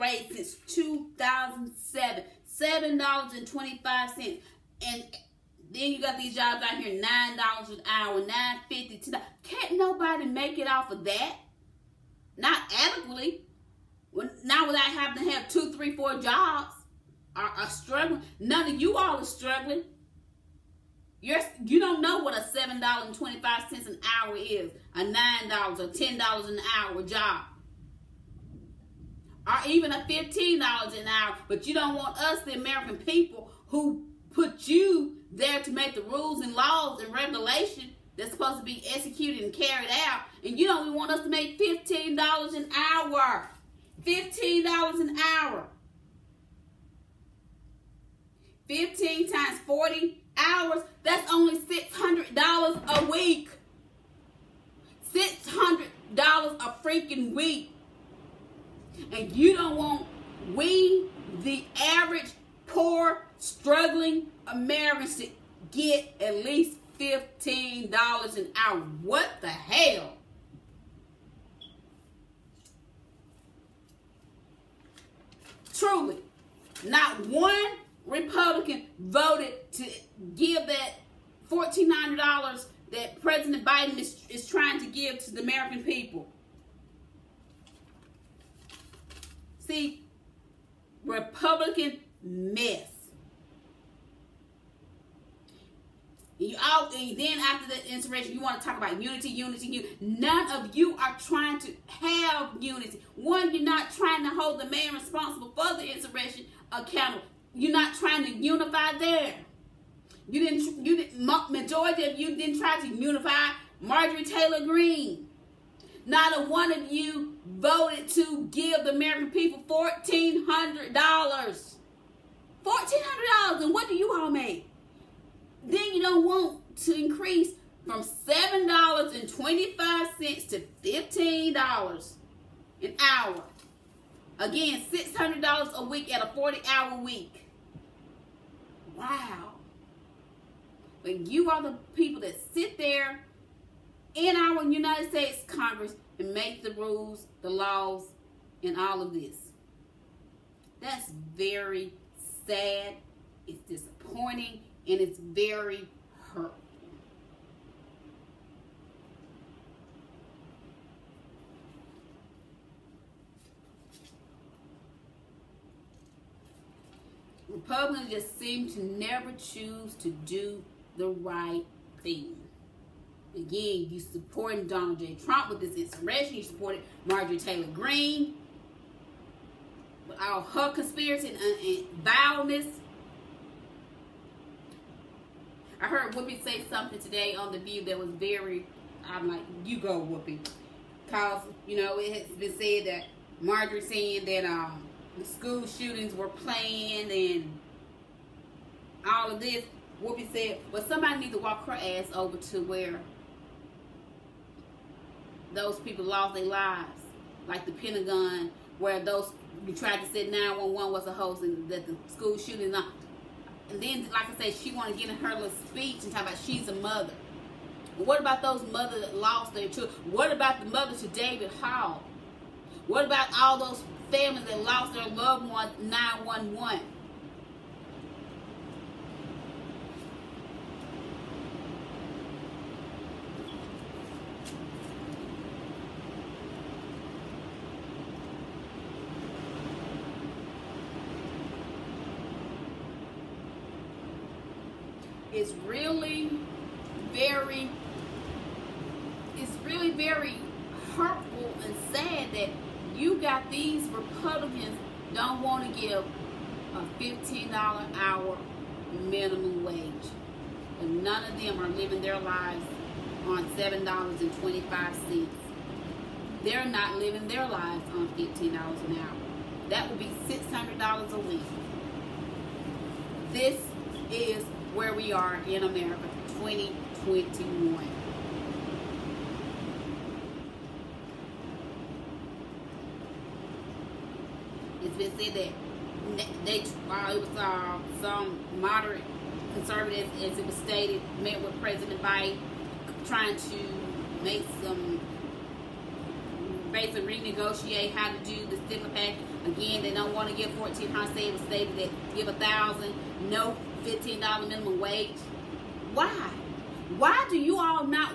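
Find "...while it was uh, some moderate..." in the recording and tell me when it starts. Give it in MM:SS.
04:46.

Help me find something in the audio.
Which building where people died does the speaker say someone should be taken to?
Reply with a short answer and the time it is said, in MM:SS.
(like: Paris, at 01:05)
the Pentagon, at 03:27.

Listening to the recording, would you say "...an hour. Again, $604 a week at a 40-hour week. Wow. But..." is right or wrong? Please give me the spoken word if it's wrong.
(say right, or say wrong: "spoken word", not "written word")
wrong: "600", not "604".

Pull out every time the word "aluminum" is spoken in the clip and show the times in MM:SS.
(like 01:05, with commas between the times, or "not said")
not said.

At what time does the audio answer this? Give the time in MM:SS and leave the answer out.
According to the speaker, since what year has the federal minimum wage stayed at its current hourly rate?
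00:00.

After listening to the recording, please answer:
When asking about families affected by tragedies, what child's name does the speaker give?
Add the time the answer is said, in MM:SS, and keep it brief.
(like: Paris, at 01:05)
David Hall, at 03:41.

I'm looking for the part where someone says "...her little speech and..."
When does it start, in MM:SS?
03:35.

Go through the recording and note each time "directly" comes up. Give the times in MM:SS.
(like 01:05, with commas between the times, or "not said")
not said.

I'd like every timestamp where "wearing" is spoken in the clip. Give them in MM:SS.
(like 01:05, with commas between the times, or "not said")
not said.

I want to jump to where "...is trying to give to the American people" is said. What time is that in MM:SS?
01:24.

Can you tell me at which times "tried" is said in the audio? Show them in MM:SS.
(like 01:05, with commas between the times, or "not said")
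03:29.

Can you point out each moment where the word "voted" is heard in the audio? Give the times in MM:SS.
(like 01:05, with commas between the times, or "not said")
01:18, 01:57.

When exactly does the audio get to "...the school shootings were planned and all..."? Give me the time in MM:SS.
03:15.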